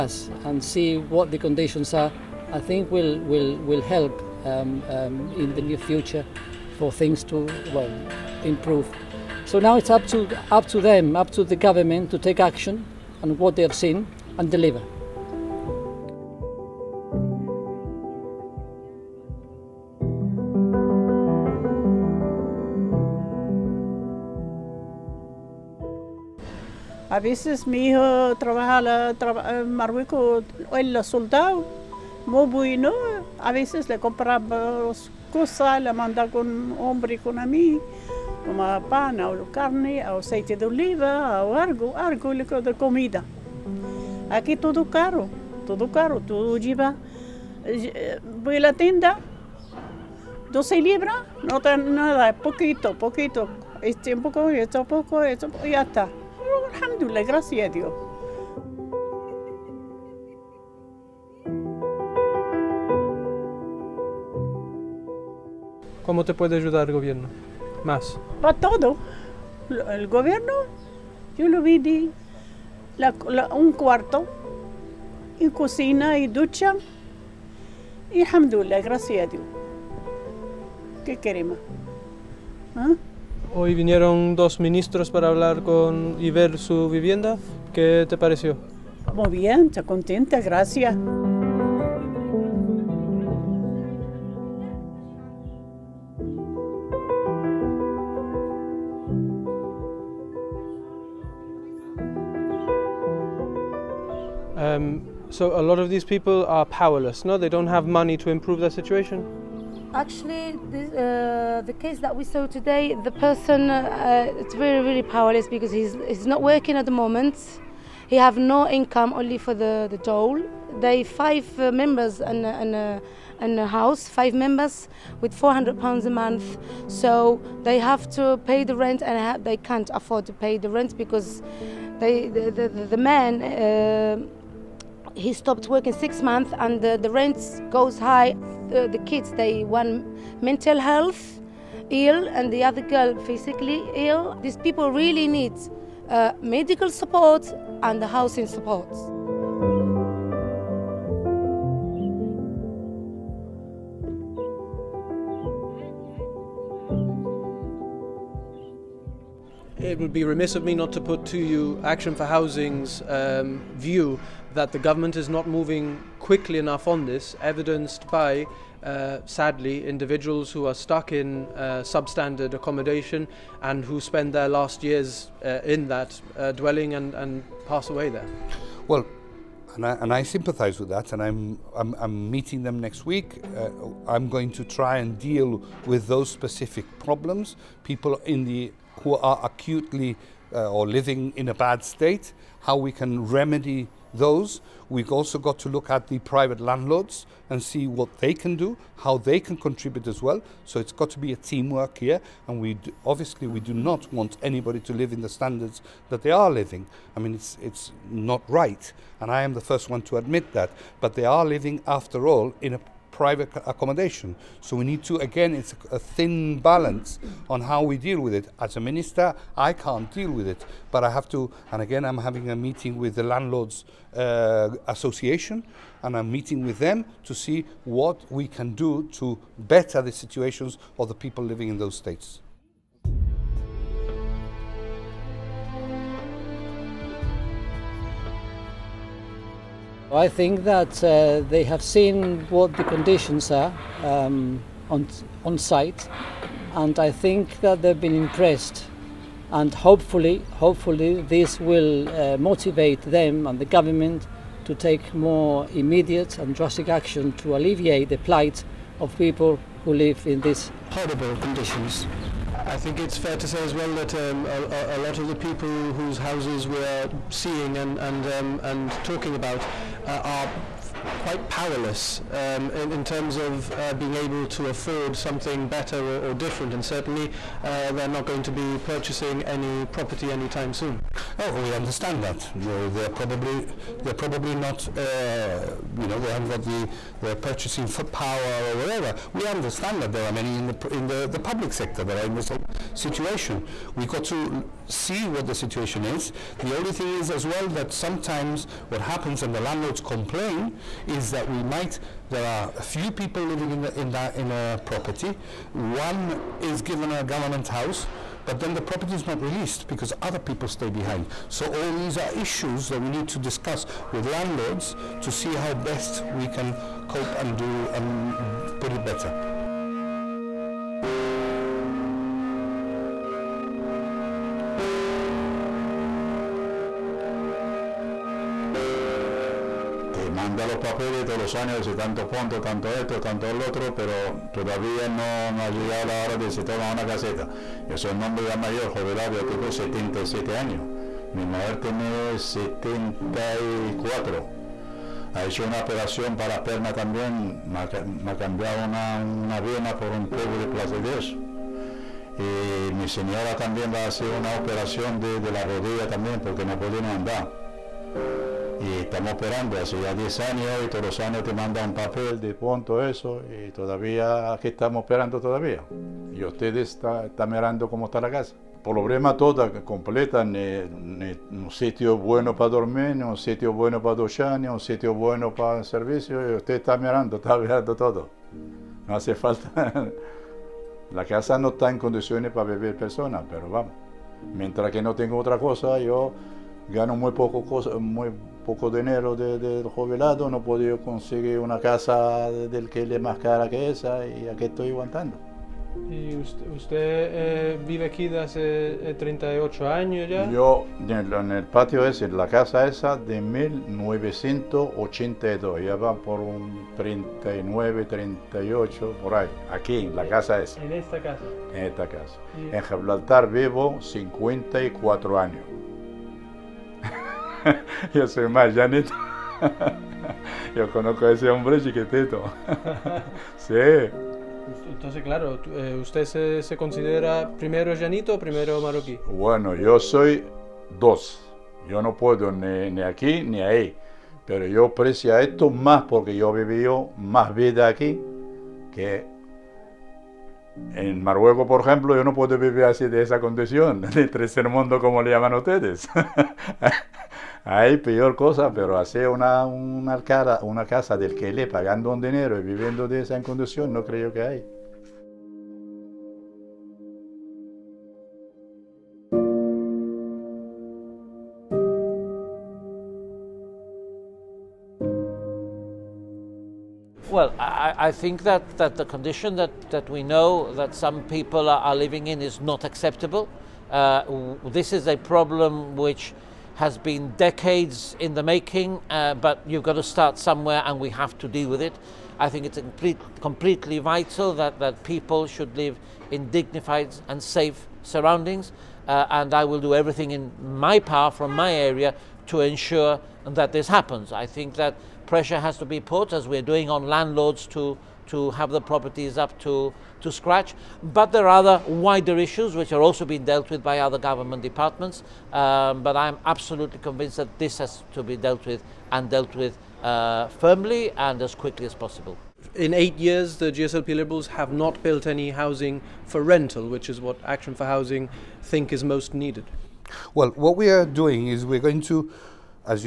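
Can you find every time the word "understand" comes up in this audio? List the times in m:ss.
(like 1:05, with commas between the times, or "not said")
4:41, 4:49.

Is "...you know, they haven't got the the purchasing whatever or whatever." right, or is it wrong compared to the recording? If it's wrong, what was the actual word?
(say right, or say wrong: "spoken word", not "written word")
wrong: "power", not "whatever".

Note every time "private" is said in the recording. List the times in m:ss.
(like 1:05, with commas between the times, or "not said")
3:16, 3:33.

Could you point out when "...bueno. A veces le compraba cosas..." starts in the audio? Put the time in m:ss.
0:32.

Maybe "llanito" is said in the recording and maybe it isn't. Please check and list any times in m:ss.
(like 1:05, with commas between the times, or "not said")
7:07.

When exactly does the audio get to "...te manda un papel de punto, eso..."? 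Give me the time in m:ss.
6:01.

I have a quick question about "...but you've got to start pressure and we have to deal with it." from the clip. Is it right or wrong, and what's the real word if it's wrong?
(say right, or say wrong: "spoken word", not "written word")
wrong: "somewhere", not "pressure".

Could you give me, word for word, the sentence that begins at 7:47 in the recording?
Well, I, I, think that, that the condition that, that we know that some people are, are living in is not acceptable.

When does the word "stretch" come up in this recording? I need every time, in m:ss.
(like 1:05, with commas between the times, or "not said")
not said.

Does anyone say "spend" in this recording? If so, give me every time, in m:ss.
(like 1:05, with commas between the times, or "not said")
2:53.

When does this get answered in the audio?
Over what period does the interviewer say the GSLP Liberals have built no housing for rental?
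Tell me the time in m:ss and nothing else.
8:32.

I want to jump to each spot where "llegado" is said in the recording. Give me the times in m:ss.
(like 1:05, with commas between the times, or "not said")
5:35.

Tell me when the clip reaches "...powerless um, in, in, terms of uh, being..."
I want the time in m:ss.
4:31.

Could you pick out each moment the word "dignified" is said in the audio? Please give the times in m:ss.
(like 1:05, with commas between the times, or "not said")
8:06.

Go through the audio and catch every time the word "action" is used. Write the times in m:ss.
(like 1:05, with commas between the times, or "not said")
0:12, 2:41, 4:16, 8:37.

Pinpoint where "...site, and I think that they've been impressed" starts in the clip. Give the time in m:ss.
4:05.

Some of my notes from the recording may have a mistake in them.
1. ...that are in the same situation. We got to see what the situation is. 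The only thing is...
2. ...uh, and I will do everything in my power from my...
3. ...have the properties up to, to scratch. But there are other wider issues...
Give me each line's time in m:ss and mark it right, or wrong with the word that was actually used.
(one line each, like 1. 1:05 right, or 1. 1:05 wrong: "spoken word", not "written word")
1. 4:52 right
2. 8:09 right
3. 8:18 right.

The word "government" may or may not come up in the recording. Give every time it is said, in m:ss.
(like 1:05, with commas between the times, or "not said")
0:11, 2:44, 4:13, 5:07, 8:24.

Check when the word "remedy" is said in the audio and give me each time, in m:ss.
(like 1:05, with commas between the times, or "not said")
3:13.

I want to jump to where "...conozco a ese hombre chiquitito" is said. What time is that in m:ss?
7:00.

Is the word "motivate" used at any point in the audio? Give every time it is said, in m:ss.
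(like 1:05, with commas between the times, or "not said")
4:12.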